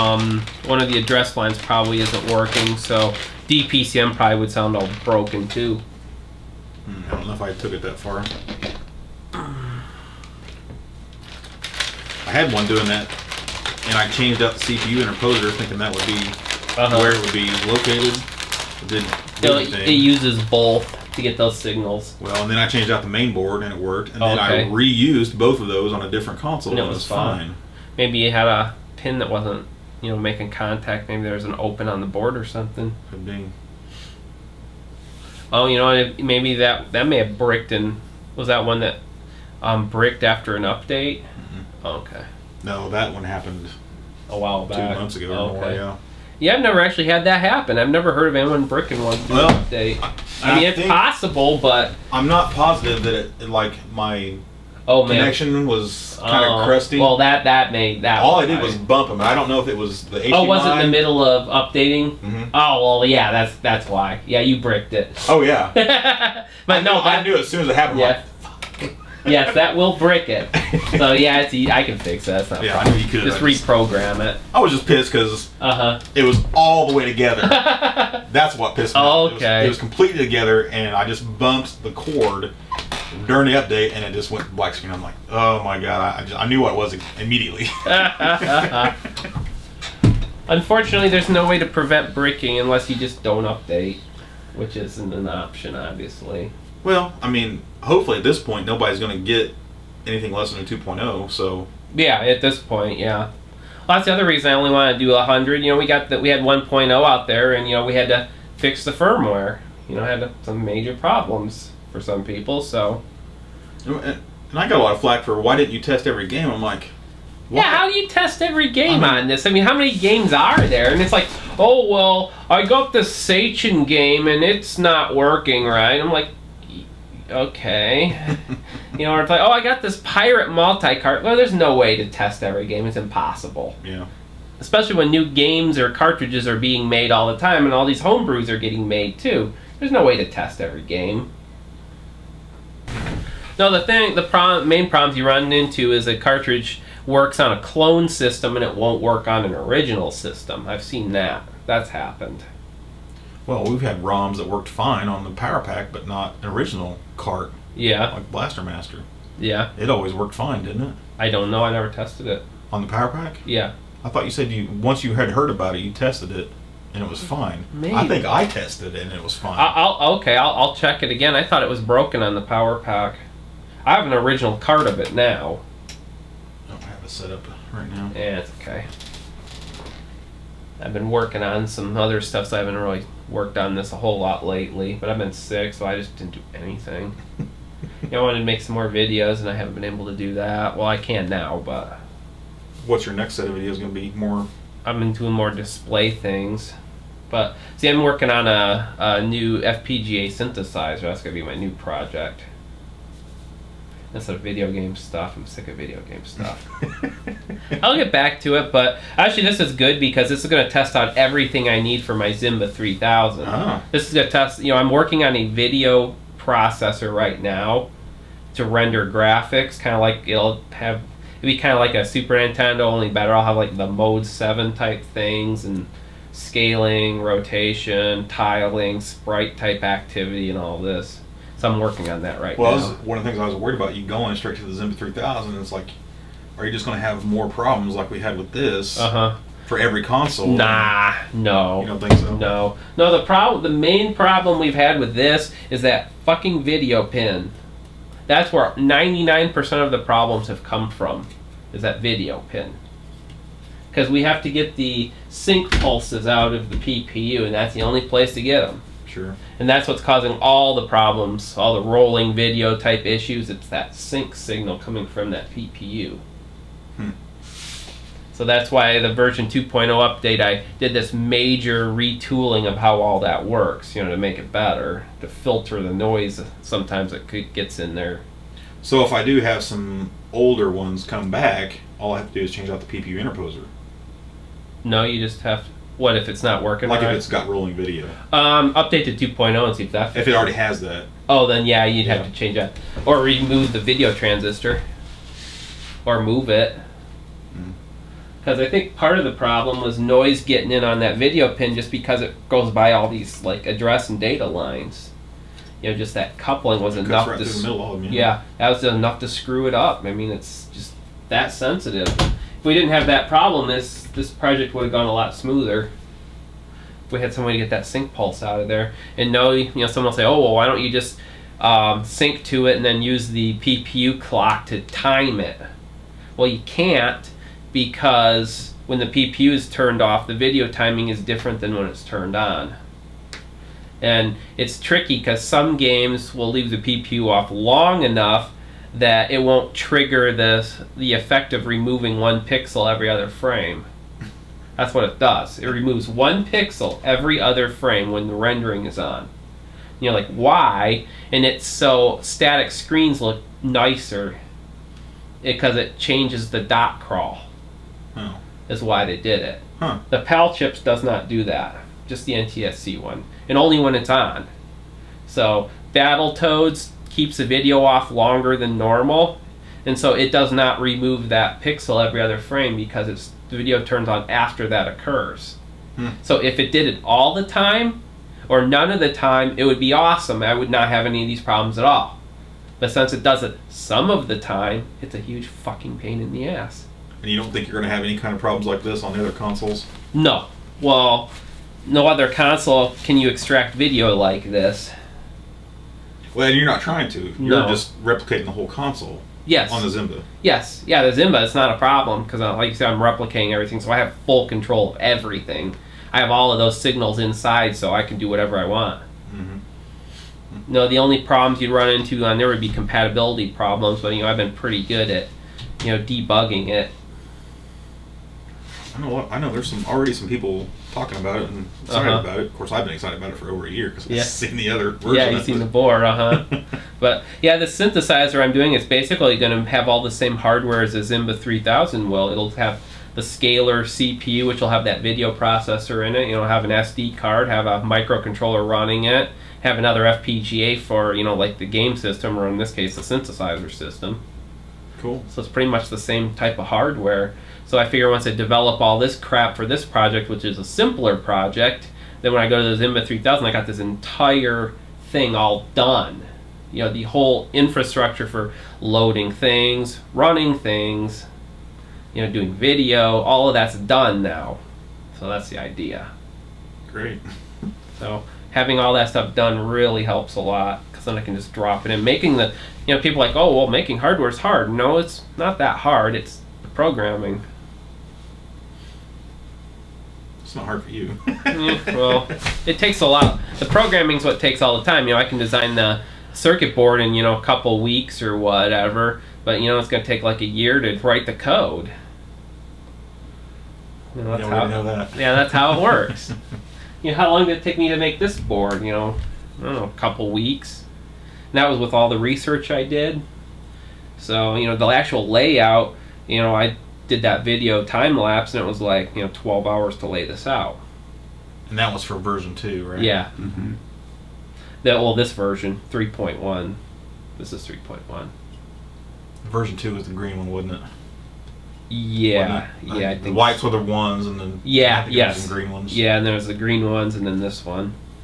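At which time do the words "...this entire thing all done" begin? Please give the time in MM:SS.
07:33.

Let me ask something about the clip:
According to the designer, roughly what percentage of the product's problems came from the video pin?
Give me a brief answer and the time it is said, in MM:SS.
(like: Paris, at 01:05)
99%, at 04:08.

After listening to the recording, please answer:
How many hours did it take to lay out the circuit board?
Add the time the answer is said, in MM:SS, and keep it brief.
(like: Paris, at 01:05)
12, at 08:29.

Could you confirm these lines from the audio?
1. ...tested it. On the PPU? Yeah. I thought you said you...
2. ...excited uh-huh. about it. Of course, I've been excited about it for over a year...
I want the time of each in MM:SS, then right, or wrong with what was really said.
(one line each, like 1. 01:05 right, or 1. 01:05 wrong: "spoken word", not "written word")
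1. 02:41 wrong: "PowerPak", not "PPU"
2. 07:01 right.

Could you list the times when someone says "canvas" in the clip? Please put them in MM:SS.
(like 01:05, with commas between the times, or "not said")
not said.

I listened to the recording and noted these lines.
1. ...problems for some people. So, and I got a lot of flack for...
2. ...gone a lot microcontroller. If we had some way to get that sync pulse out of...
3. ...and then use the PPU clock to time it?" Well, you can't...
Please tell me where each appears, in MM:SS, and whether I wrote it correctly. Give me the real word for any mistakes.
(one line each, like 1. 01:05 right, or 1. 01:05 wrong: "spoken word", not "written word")
1. 01:50 right
2. 05:14 wrong: "smoother", not "microcontroller"
3. 05:22 right.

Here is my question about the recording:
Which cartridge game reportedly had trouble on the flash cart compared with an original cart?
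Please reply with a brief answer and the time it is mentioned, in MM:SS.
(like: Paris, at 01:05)
Blaster Master, at 02:38.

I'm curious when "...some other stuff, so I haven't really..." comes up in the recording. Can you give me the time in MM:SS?
03:01.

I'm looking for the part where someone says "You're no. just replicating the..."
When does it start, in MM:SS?
06:37.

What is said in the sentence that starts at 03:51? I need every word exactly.
So I'm working on that right well, now.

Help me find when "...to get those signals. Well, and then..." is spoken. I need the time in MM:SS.
00:21.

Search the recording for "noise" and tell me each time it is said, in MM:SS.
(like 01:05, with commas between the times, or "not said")
04:35, 04:59.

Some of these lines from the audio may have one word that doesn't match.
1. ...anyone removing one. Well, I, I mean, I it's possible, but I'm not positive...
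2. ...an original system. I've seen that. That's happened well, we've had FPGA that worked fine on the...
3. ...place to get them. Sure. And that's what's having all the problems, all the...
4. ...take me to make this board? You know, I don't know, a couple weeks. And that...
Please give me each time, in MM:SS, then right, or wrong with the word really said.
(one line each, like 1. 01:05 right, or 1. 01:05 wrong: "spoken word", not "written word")
1. 00:48 wrong: "bricking", not "removing"
2. 02:29 wrong: "ROMs", not "FPGA"
3. 04:18 wrong: "causing", not "having"
4. 08:17 right.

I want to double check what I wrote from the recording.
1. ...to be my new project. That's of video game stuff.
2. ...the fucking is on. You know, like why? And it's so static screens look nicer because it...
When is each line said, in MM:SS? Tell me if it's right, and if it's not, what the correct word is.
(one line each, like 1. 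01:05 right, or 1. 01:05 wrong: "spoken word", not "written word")
1. 03:21 right
2. 05:48 wrong: "rendering", not "fucking".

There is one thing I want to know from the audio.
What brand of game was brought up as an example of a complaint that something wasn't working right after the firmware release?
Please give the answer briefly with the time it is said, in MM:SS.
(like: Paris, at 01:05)
Sachen, at 02:03.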